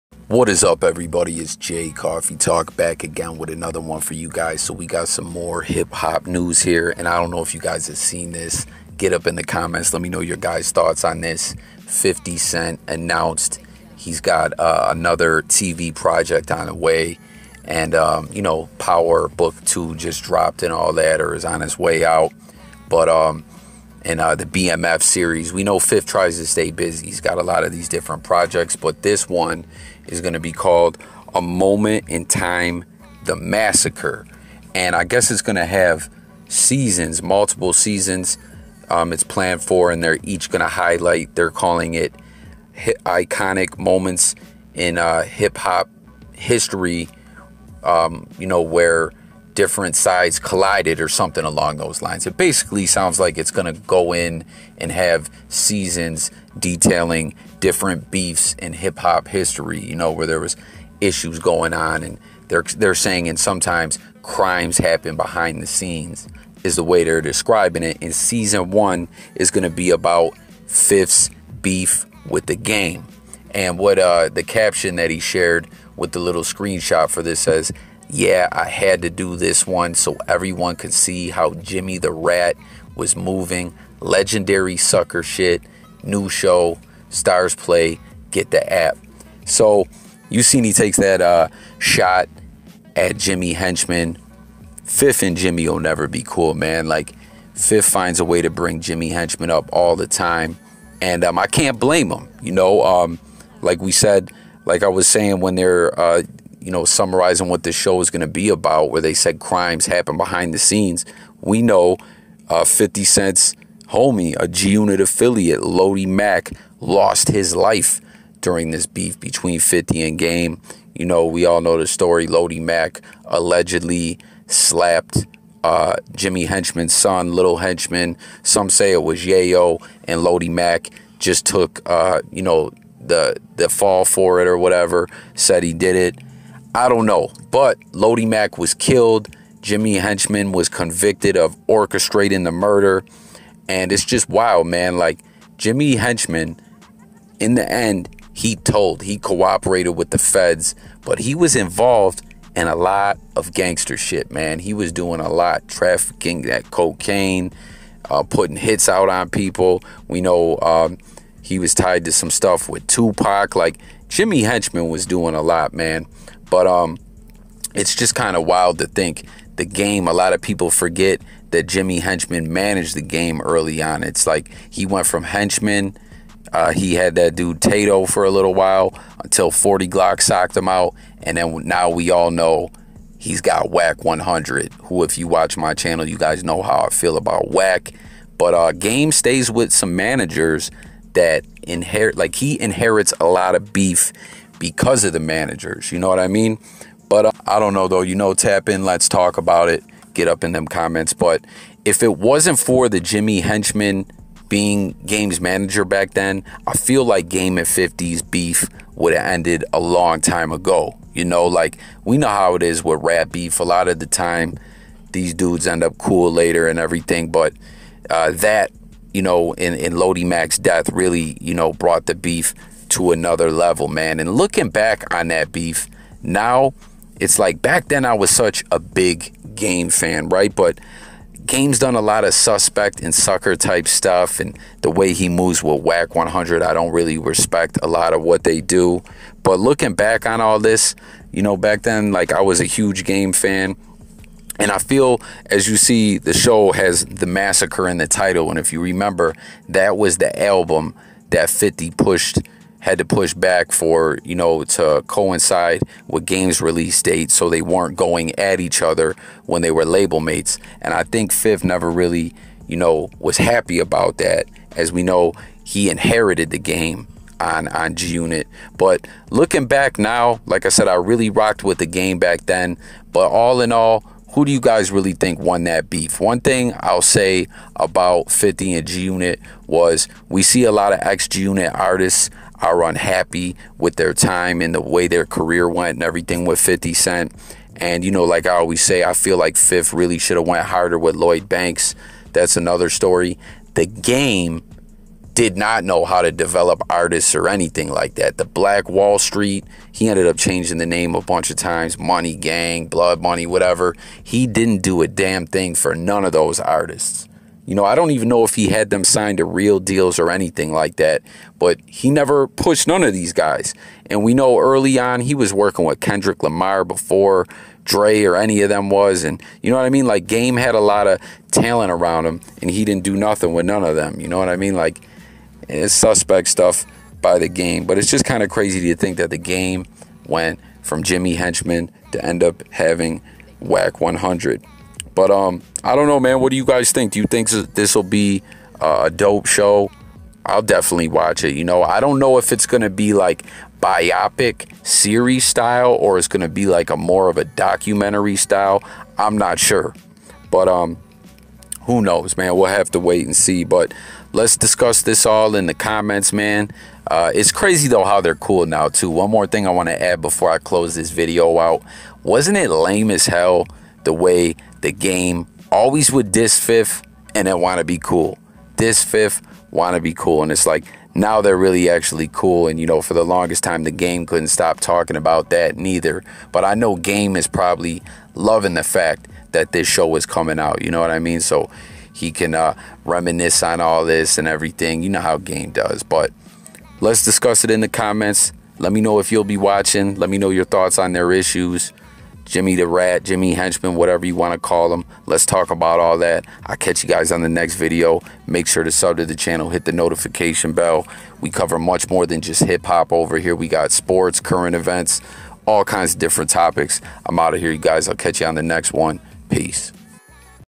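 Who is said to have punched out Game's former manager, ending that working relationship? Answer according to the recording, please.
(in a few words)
40 Glock.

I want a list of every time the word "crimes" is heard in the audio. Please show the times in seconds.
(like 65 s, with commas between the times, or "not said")
64 s, 109 s.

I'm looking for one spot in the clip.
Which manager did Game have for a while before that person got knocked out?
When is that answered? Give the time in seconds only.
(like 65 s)
177 s.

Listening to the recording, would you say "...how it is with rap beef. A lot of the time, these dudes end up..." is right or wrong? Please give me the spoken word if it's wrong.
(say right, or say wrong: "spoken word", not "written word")
right.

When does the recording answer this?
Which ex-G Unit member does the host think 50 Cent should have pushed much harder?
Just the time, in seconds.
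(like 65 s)
291 s.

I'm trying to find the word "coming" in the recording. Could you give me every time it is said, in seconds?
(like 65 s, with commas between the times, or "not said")
380 s.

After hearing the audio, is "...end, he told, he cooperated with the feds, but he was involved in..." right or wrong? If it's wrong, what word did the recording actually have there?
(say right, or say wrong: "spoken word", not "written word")
right.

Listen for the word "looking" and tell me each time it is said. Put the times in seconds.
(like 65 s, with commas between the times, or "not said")
224 s, 239 s, 269 s.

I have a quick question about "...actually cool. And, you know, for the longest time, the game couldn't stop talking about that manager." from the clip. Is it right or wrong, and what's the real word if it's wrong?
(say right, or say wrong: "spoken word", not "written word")
wrong: "neither", not "manager".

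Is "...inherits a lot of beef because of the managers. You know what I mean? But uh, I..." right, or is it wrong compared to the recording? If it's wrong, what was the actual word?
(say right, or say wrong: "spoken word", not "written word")
right.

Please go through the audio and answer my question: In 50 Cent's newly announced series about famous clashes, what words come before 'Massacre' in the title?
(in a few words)
A Moment in Time.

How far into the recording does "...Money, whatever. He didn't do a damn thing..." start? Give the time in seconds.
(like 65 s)
303 s.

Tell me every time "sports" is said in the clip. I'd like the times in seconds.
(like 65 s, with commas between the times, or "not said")
403 s.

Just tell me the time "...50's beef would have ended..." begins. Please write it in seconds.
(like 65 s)
207 s.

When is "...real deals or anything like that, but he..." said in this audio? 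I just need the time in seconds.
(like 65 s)
309 s.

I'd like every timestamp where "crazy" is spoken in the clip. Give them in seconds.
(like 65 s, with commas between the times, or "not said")
328 s, 357 s.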